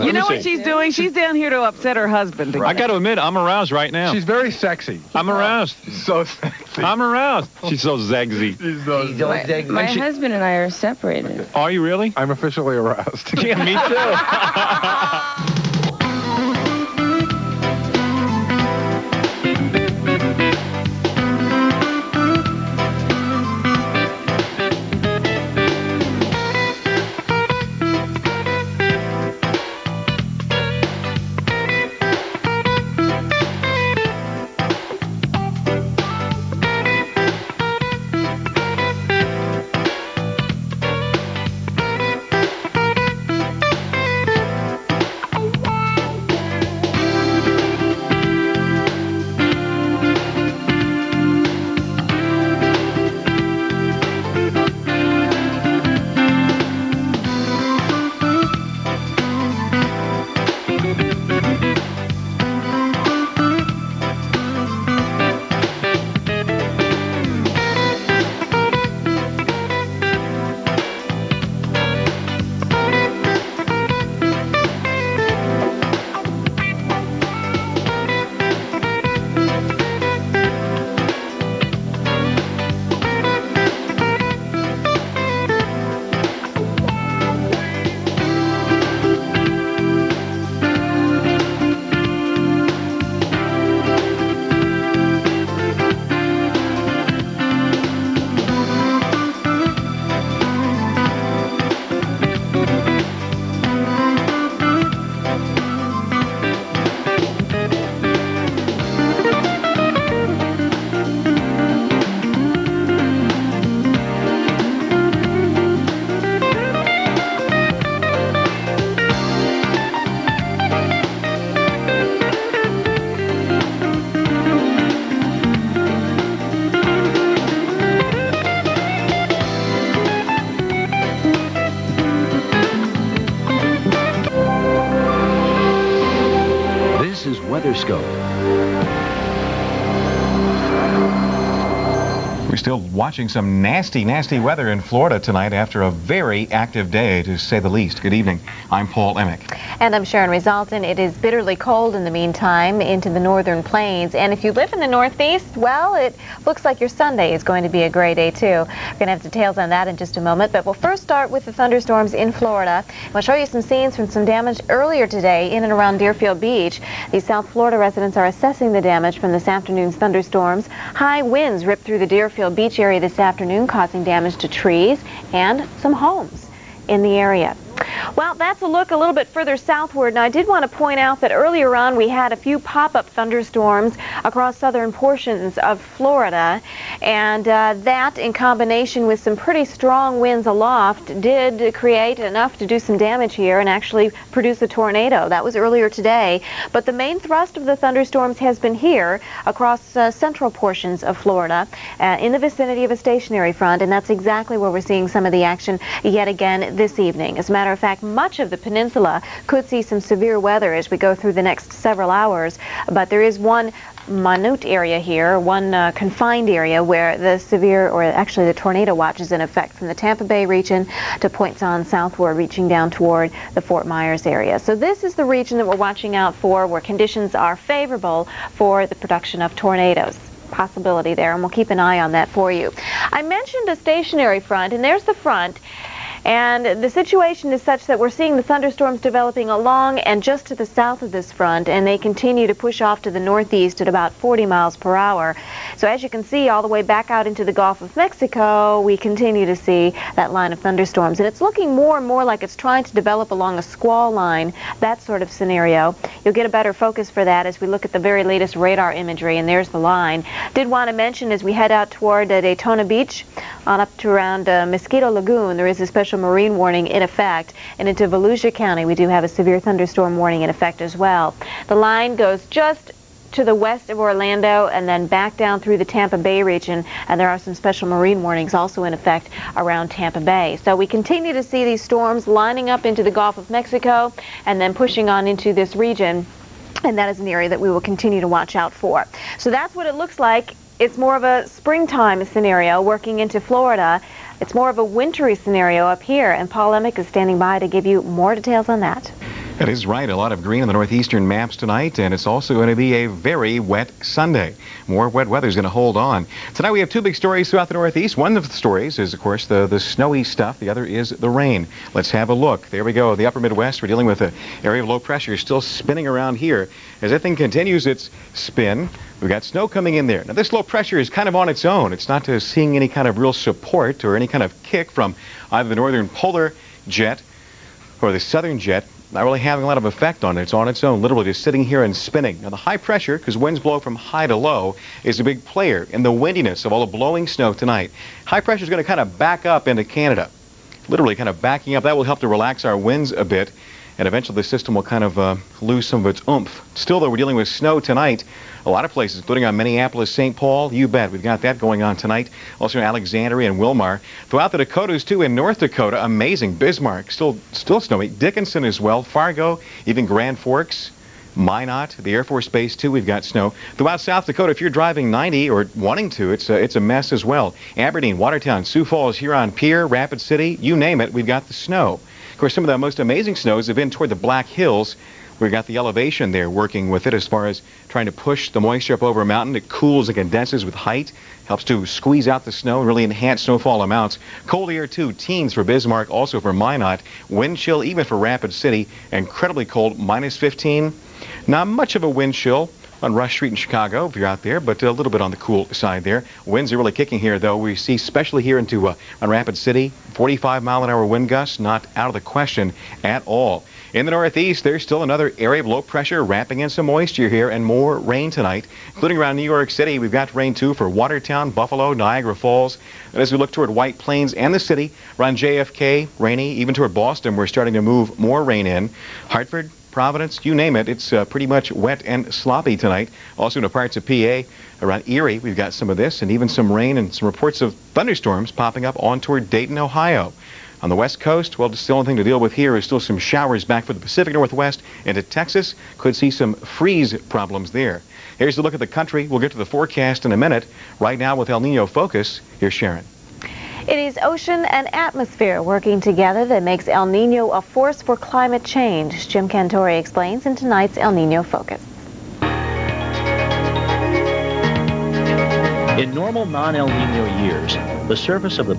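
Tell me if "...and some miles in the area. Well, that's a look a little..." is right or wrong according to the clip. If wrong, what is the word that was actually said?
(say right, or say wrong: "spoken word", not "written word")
wrong: "homes", not "miles".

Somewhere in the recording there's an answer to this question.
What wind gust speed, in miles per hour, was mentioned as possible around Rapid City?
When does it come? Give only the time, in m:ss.
6:40.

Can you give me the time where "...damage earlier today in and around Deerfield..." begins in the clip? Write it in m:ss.
2:44.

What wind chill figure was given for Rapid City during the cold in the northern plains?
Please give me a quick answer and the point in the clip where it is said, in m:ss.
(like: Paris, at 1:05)
-15, at 6:29.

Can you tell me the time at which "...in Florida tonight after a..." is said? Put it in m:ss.
2:24.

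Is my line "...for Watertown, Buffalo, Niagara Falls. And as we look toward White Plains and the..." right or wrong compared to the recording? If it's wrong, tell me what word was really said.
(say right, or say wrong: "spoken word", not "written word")
right.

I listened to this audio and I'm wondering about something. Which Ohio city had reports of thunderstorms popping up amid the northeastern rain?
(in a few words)
Dayton.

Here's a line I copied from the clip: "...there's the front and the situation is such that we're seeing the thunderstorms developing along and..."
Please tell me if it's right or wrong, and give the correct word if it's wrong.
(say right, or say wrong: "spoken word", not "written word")
right.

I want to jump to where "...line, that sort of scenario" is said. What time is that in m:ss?
4:14.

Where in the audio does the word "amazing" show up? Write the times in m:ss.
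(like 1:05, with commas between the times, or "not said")
5:56, 6:12.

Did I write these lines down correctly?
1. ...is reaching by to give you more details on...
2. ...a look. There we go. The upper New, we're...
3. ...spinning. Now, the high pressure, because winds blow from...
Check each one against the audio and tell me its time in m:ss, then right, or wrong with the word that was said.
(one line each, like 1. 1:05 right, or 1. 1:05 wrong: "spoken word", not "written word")
1. 4:56 wrong: "standing", not "reaching"
2. 5:12 wrong: "Midwest", not "New"
3. 5:31 right.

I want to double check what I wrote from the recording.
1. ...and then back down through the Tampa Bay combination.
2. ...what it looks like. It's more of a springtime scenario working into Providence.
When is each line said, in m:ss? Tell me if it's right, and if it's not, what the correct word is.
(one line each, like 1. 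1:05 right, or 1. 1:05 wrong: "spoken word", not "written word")
1. 4:34 wrong: "region", not "combination"
2. 4:49 wrong: "Florida", not "Providence".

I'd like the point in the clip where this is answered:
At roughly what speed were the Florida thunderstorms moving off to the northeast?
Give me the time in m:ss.
4:04.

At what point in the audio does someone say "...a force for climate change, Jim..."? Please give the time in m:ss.
7:27.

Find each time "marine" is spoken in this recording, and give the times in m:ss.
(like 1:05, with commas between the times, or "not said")
4:26, 4:37.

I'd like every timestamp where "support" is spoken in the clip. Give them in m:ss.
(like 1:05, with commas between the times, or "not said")
5:23.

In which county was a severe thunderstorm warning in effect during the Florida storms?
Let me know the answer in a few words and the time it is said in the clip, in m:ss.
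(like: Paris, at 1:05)
Volusia County, at 4:28.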